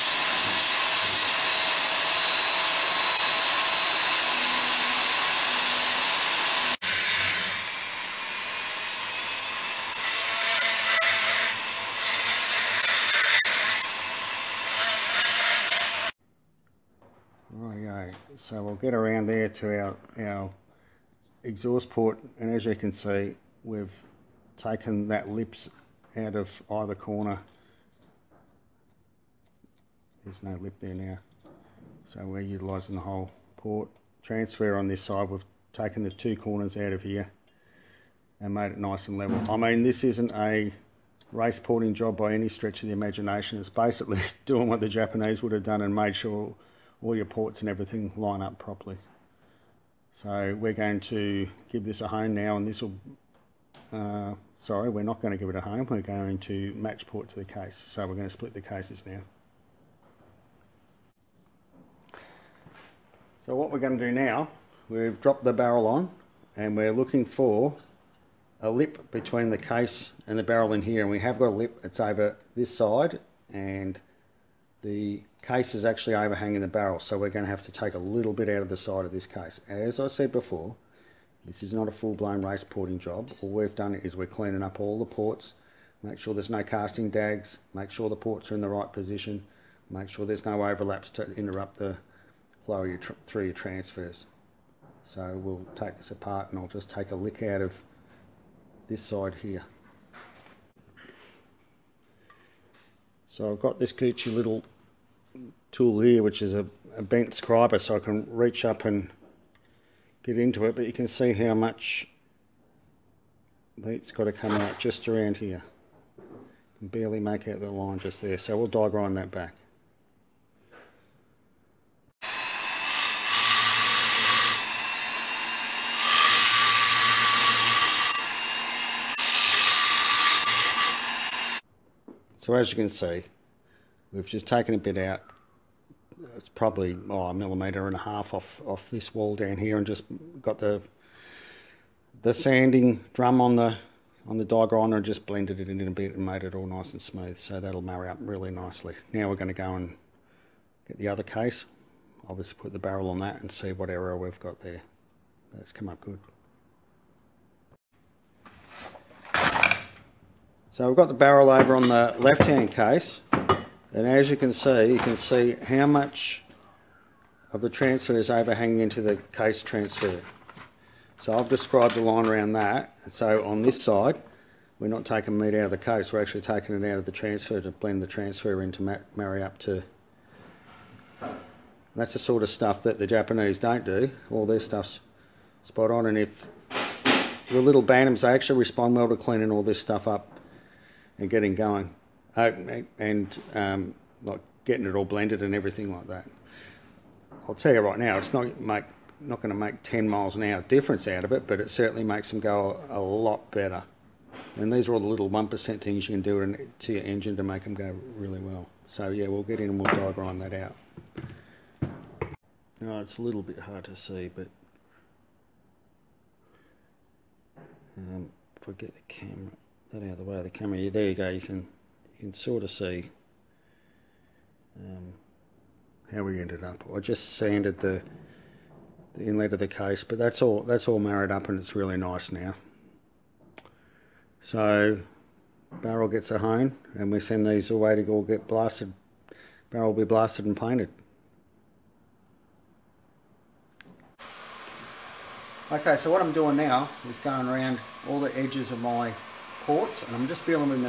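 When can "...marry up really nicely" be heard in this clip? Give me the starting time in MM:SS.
02:27.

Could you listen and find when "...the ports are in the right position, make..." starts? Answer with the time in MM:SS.
01:28.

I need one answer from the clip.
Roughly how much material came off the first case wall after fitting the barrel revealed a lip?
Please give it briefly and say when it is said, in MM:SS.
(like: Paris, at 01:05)
1.5 millimetres, at 02:17.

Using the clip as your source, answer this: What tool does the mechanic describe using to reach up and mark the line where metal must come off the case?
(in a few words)
bent scriber.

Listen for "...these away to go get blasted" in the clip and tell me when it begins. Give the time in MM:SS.
03:57.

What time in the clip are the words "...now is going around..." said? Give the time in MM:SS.
04:06.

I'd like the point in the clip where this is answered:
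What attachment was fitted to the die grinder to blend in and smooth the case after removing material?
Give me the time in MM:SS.
02:22.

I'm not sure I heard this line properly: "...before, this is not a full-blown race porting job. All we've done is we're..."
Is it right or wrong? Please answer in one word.
right.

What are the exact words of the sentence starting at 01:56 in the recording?
barely make out the line just there, so we'll die grind that back.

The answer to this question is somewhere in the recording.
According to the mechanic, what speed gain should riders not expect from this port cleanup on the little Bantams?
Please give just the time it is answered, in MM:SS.
03:19.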